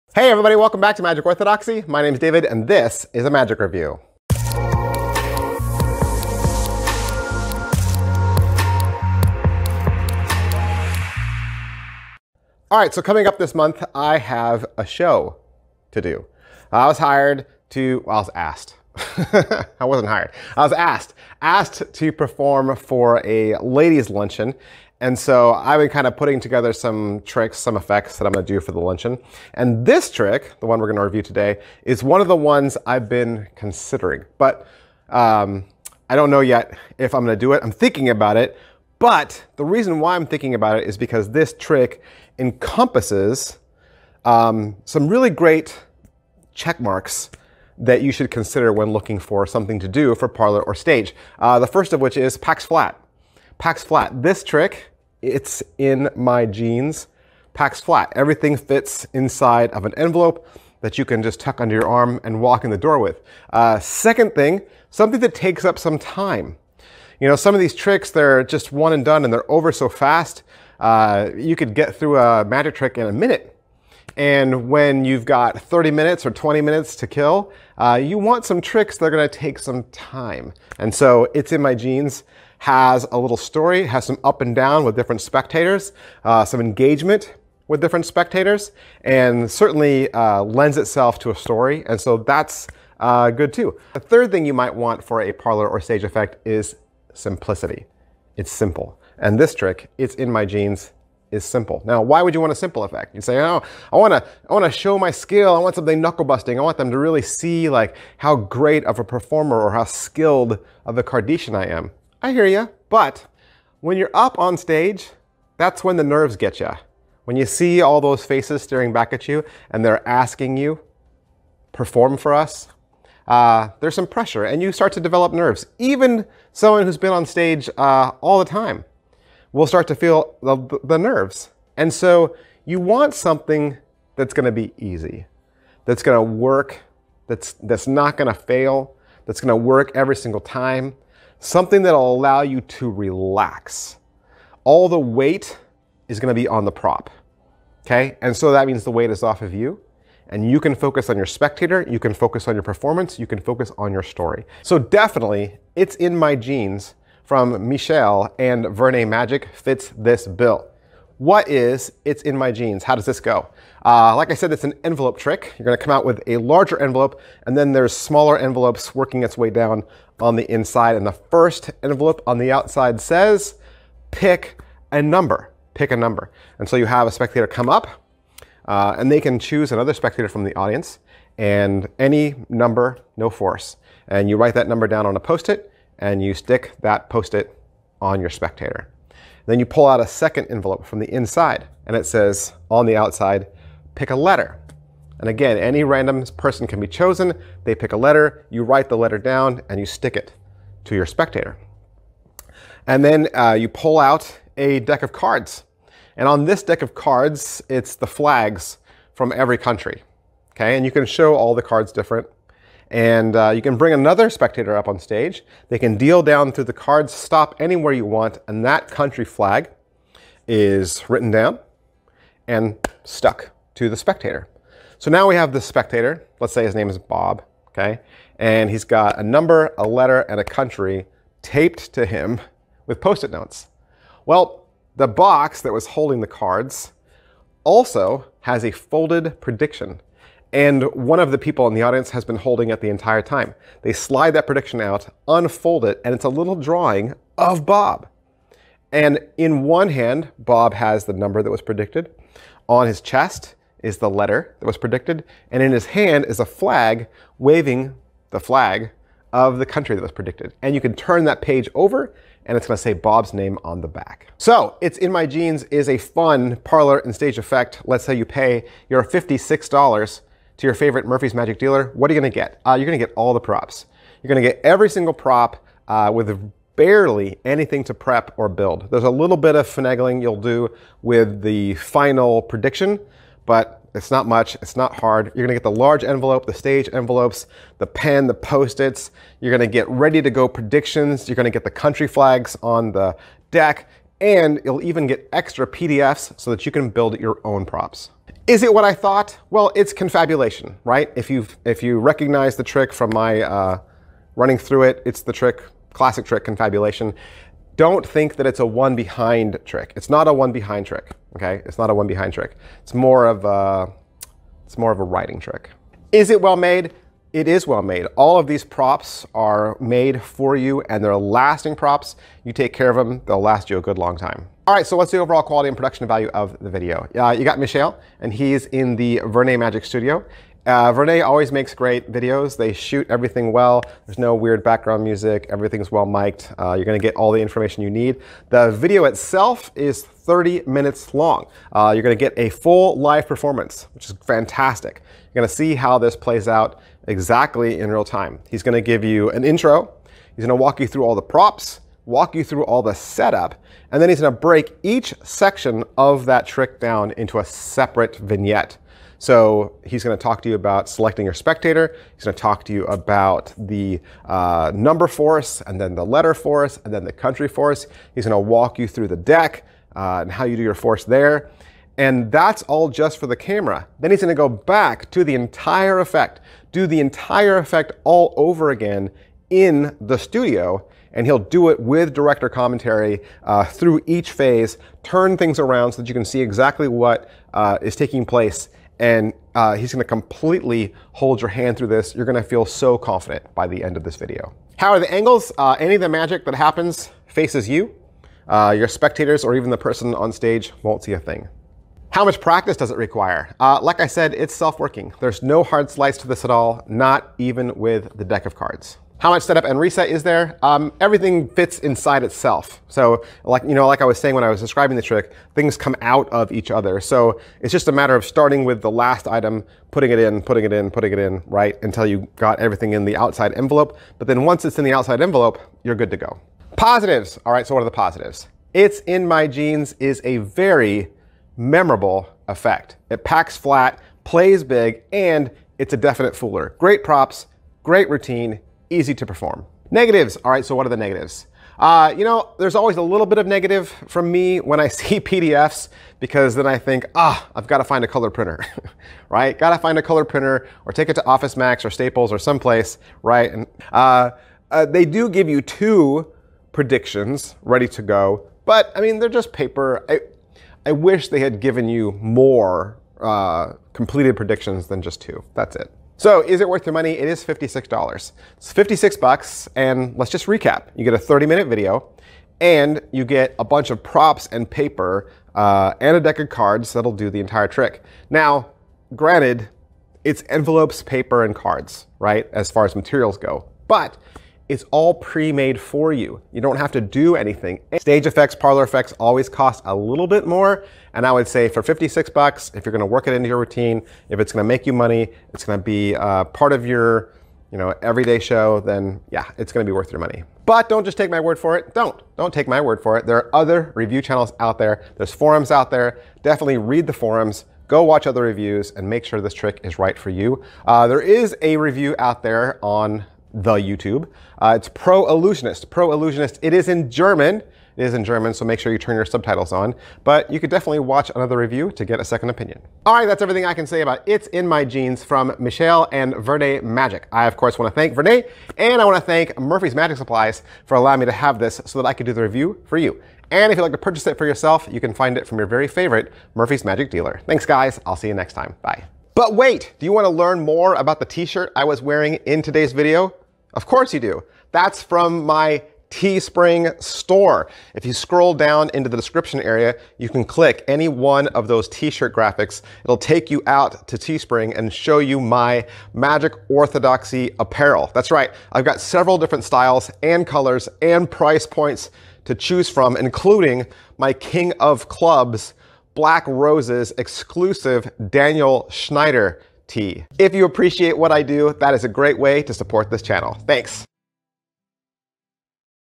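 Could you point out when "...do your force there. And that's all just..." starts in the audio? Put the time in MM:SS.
06:10.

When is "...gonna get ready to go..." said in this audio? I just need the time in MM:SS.
04:49.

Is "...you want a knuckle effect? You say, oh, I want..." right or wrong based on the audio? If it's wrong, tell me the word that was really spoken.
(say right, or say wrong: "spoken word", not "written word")
wrong: "simple", not "knuckle".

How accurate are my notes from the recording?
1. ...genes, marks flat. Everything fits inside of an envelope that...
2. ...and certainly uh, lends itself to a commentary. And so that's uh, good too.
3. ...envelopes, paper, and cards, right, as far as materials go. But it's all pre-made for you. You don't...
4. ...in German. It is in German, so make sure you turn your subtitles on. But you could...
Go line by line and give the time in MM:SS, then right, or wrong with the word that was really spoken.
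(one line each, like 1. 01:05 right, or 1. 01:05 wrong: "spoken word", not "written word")
1. 00:56 wrong: "packs", not "marks"
2. 01:29 wrong: "story", not "commentary"
3. 08:00 right
4. 08:36 right.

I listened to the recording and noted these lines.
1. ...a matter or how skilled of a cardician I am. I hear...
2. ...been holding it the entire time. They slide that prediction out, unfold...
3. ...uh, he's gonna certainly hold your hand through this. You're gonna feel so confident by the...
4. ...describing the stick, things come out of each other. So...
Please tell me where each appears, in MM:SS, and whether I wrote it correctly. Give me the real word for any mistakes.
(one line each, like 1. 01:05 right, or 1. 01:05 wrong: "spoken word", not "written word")
1. 01:48 wrong: "performer", not "matter"
2. 04:02 right
3. 06:29 wrong: "completely", not "certainly"
4. 06:54 wrong: "trick", not "stick".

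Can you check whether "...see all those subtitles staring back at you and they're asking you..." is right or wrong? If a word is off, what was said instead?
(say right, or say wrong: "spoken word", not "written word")
wrong: "faces", not "subtitles".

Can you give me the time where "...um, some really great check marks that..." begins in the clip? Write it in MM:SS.
00:44.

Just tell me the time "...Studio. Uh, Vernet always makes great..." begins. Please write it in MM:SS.
05:29.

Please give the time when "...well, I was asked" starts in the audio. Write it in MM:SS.
00:18.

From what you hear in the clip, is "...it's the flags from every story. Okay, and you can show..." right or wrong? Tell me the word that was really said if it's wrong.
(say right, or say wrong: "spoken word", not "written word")
wrong: "country", not "story".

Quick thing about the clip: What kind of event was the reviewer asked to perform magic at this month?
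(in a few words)
Ladies luncheon.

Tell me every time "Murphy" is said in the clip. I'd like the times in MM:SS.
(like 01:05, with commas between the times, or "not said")
04:31, 08:49, 08:56.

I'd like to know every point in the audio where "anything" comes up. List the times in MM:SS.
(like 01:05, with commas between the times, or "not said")
04:37, 08:07.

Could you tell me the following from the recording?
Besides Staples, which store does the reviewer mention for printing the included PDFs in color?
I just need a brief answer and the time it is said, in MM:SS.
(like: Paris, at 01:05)
Office Max, at 07:31.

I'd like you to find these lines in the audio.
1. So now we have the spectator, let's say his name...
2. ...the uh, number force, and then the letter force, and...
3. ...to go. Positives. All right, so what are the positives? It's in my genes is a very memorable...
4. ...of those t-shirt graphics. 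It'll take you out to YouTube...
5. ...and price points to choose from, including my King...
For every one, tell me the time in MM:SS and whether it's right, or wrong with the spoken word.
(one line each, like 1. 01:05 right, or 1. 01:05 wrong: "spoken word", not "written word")
1. 03:44 right
2. 06:03 right
3. 07:06 right
4. 09:11 wrong: "Teespring", not "YouTube"
5. 09:21 right.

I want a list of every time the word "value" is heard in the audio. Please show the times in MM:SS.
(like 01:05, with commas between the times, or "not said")
05:26.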